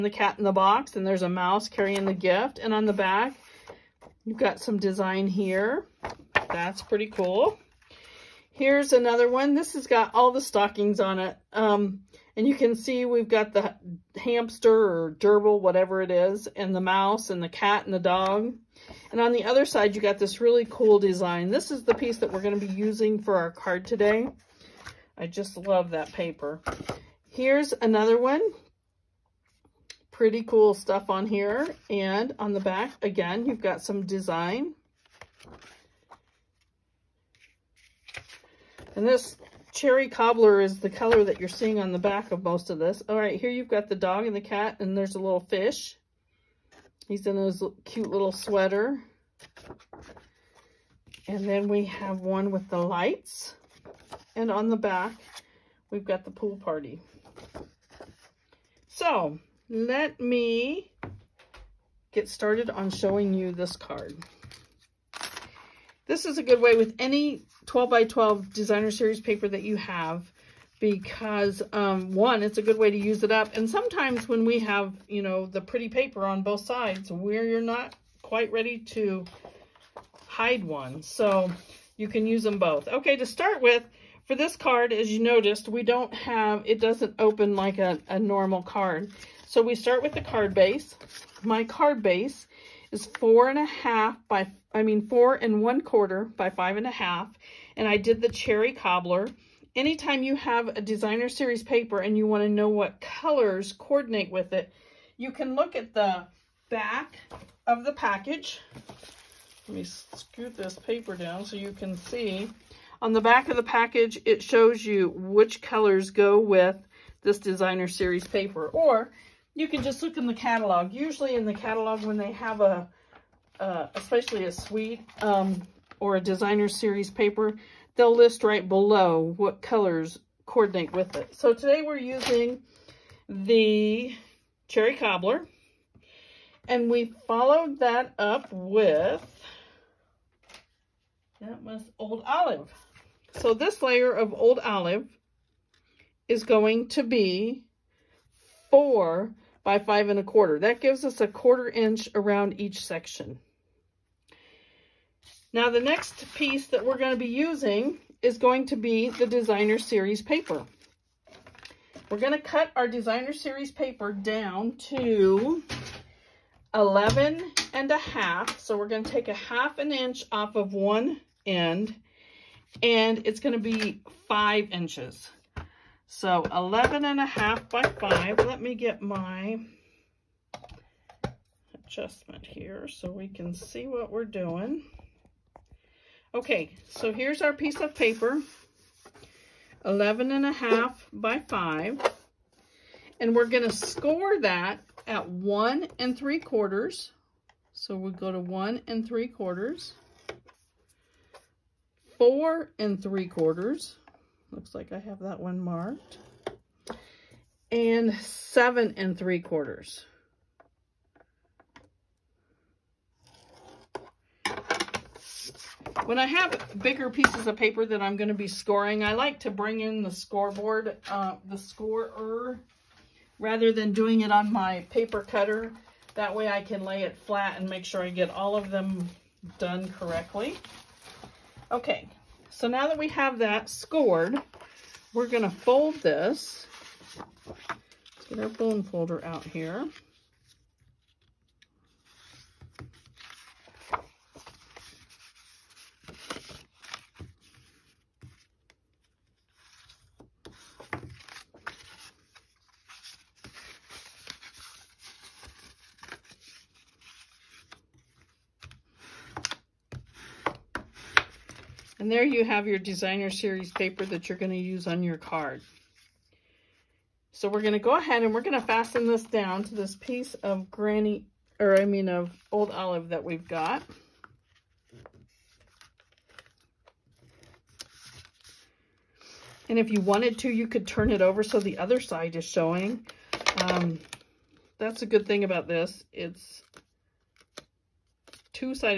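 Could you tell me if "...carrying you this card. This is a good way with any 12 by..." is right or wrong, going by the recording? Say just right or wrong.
wrong.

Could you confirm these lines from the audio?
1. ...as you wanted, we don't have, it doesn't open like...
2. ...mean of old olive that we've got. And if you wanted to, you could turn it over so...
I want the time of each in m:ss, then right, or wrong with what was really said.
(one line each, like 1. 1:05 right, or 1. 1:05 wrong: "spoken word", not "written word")
1. 1:24 wrong: "noticed", not "wanted"
2. 4:31 right.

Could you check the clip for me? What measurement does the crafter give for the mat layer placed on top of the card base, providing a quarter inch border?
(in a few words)
4 by 5 1/4.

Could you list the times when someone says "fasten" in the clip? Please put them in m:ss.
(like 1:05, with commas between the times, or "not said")
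4:28.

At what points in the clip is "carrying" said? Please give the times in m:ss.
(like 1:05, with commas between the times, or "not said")
0:01.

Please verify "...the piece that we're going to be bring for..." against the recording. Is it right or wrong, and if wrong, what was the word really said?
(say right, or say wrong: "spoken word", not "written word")
wrong: "using", not "bring".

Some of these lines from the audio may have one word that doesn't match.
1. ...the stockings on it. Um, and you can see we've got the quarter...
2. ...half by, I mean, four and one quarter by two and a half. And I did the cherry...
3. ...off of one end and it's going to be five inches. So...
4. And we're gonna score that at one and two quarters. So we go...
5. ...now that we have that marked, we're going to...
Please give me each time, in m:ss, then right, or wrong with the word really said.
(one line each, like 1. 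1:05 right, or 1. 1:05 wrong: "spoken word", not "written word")
1. 0:10 wrong: "hamster", not "quarter"
2. 1:33 wrong: "five", not "two"
3. 2:50 right
4. 3:13 wrong: "three", not "two"
5. 3:52 wrong: "scored", not "marked".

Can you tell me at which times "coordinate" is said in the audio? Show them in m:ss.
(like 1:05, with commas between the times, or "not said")
1:43, 2:10.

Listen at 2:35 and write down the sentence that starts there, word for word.
Now the next piece that we're going to be using is going to be the designer series paper.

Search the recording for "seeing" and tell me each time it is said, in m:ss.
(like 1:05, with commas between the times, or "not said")
0:41.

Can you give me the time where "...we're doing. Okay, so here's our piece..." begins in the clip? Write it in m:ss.
3:04.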